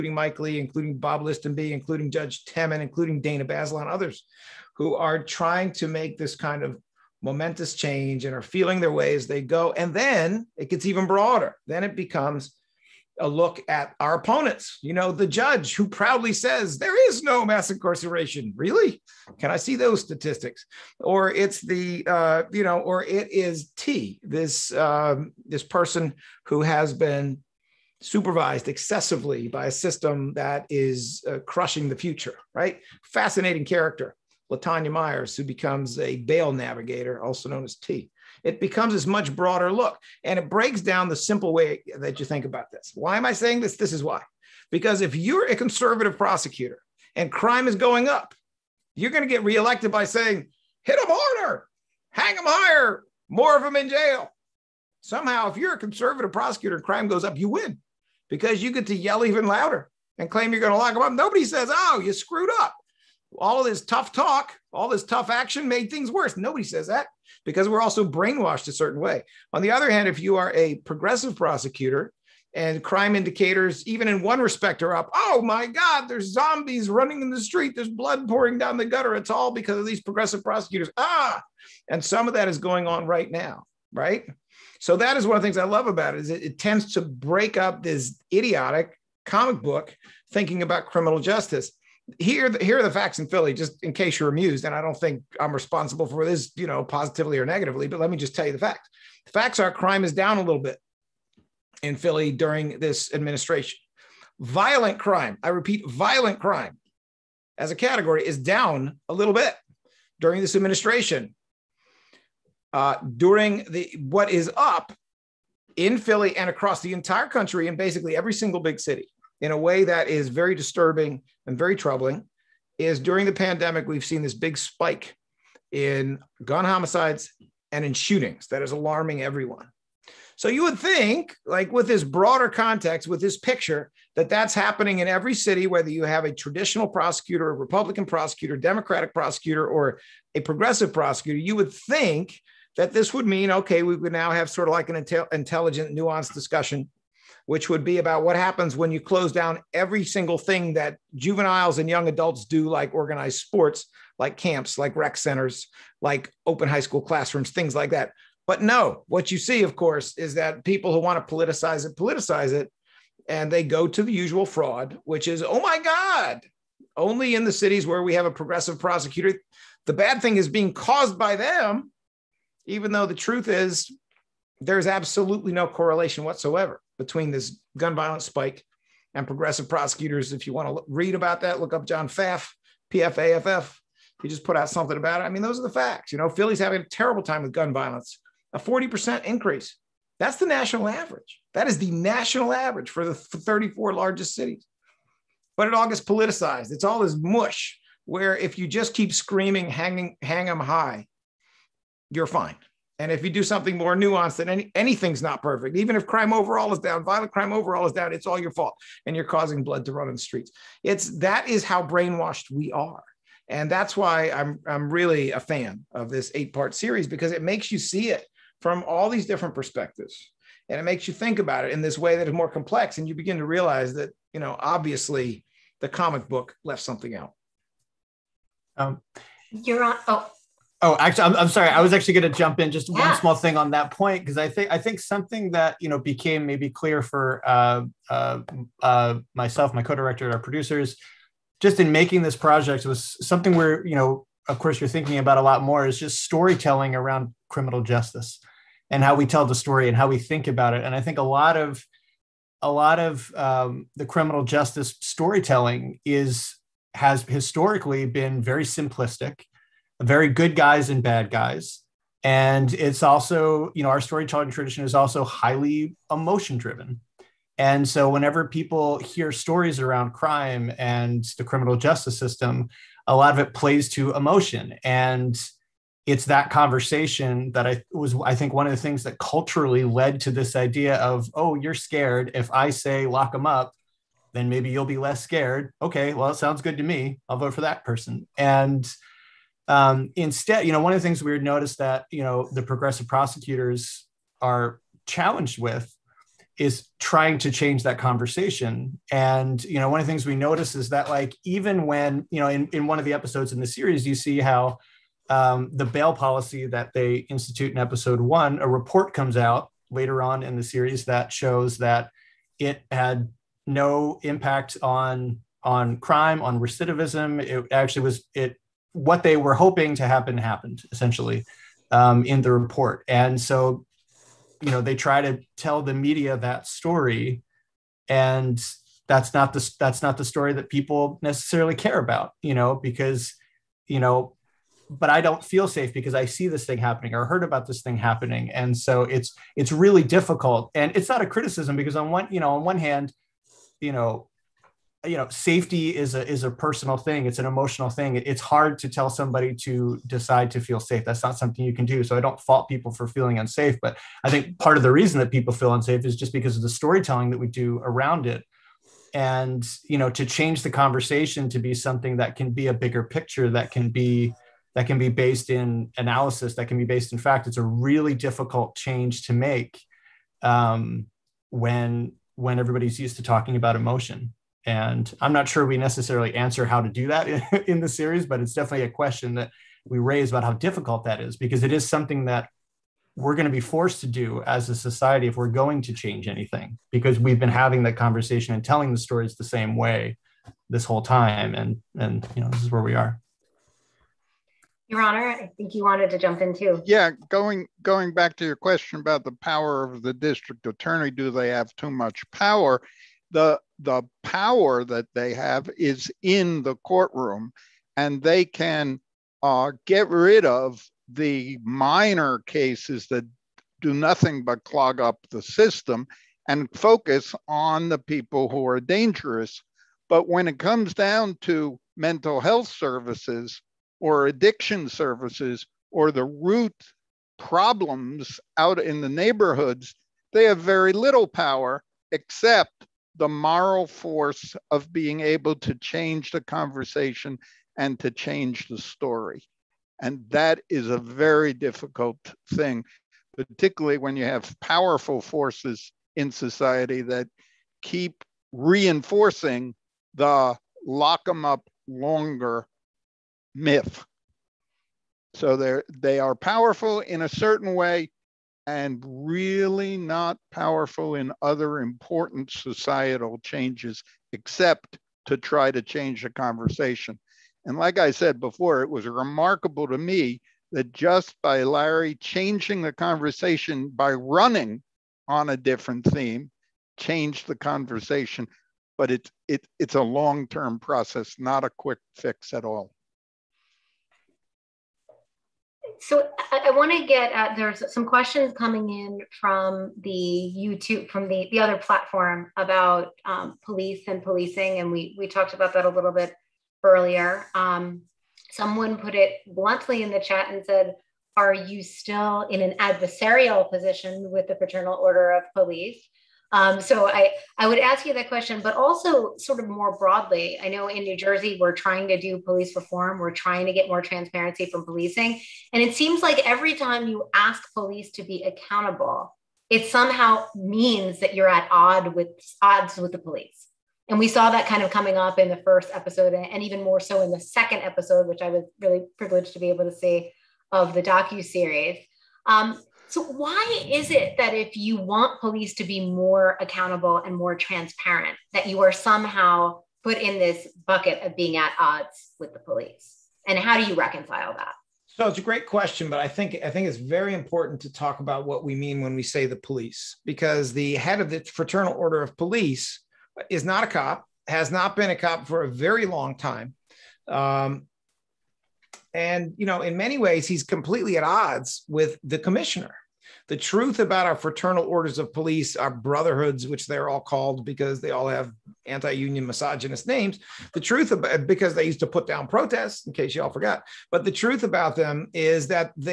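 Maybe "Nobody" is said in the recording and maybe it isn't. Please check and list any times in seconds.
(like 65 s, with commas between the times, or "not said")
61 s, 66 s.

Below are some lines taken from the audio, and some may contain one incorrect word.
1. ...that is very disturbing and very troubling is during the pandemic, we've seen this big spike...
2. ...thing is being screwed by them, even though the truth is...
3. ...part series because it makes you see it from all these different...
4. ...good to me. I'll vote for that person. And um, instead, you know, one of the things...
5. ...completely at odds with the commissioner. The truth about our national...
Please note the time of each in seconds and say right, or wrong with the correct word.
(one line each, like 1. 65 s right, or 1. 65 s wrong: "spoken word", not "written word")
1. 119 s right
2. 170 s wrong: "caused", not "screwed"
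3. 216 s right
4. 286 s right
5. 560 s wrong: "fraternal", not "national".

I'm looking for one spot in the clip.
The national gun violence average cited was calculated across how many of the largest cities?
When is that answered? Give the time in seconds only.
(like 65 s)
193 s.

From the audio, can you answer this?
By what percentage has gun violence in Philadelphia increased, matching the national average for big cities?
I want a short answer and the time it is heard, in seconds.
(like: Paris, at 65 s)
40%, at 188 s.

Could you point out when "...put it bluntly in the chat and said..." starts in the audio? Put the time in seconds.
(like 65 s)
498 s.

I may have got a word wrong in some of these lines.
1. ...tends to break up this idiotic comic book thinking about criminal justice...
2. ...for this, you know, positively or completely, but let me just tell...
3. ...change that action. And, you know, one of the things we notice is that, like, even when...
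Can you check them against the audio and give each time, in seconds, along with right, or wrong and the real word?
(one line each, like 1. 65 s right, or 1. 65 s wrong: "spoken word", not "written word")
1. 86 s right
2. 96 s wrong: "negatively", not "completely"
3. 297 s wrong: "conversation", not "action".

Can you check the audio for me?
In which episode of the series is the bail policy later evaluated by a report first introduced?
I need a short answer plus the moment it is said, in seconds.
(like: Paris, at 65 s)
Episode one, at 307 s.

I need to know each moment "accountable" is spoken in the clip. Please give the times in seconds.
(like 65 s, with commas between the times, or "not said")
518 s, 536 s.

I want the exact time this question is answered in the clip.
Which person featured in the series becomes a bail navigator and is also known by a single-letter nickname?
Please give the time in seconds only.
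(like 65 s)
34 s.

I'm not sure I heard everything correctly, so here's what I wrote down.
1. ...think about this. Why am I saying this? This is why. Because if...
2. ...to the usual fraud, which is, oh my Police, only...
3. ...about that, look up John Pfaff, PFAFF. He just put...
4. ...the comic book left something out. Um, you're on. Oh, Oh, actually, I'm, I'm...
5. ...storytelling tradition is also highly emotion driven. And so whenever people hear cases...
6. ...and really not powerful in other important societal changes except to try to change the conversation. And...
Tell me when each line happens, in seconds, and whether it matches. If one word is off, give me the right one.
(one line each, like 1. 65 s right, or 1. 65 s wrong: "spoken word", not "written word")
1. 42 s right
2. 163 s wrong: "God", not "Police"
3. 181 s right
4. 225 s right
5. 264 s wrong: "stories", not "cases"
6. 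458 s right.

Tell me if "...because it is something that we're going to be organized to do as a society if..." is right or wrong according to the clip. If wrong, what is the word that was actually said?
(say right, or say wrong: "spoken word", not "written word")
wrong: "forced", not "organized".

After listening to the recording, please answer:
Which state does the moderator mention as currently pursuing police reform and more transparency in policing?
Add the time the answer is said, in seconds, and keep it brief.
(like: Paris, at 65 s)
New Jersey, at 511 s.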